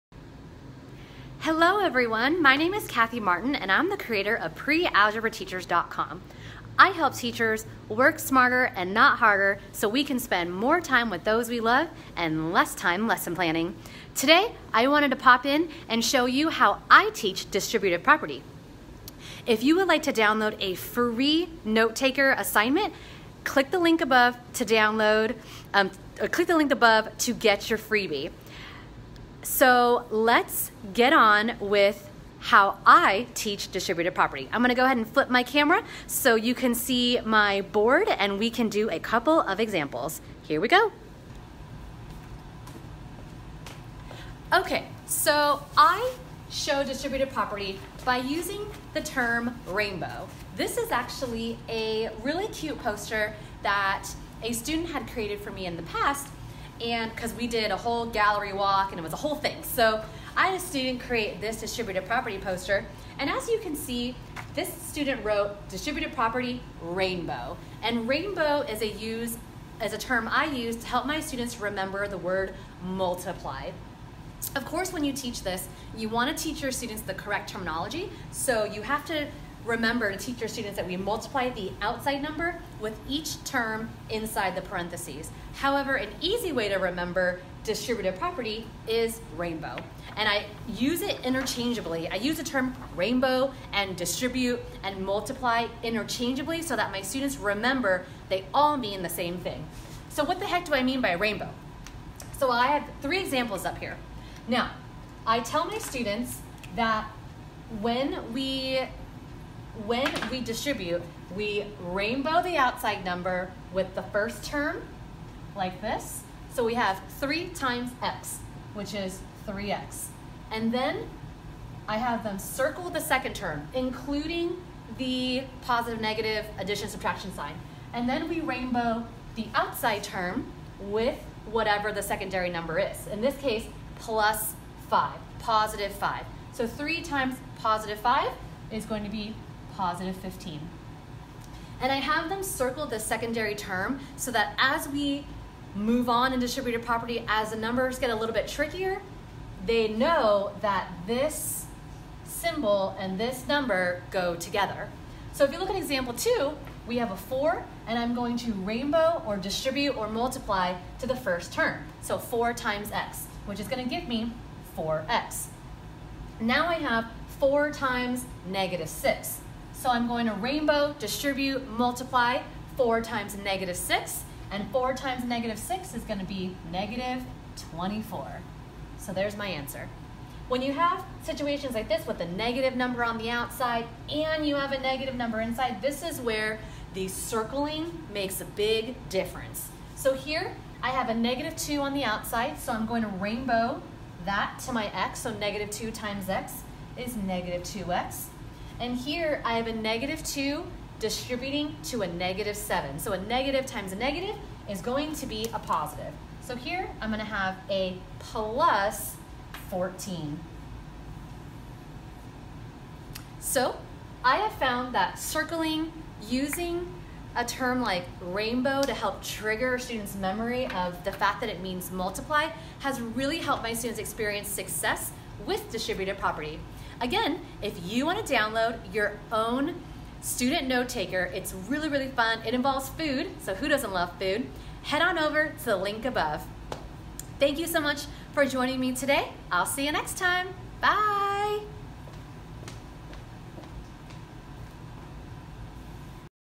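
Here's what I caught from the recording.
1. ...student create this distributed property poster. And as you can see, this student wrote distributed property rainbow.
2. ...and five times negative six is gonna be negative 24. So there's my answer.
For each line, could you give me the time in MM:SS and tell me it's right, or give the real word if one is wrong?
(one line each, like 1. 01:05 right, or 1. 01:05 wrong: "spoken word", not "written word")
1. 01:00 right
2. 02:54 wrong: "four", not "five".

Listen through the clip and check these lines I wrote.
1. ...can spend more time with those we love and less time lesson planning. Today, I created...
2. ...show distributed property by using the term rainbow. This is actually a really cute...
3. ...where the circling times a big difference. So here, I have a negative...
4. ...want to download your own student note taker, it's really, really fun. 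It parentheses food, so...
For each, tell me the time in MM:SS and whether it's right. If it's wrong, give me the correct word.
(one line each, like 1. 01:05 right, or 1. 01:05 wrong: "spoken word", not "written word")
1. 00:10 wrong: "wanted", not "created"
2. 00:46 right
3. 03:06 wrong: "makes", not "times"
4. 03:48 wrong: "involves", not "parentheses".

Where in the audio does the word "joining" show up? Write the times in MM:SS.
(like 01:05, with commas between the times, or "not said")
03:58.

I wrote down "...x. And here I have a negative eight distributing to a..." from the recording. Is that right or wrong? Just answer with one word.
wrong.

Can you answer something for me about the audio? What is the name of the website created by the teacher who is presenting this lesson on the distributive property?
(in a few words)
prealgebrateachers.com.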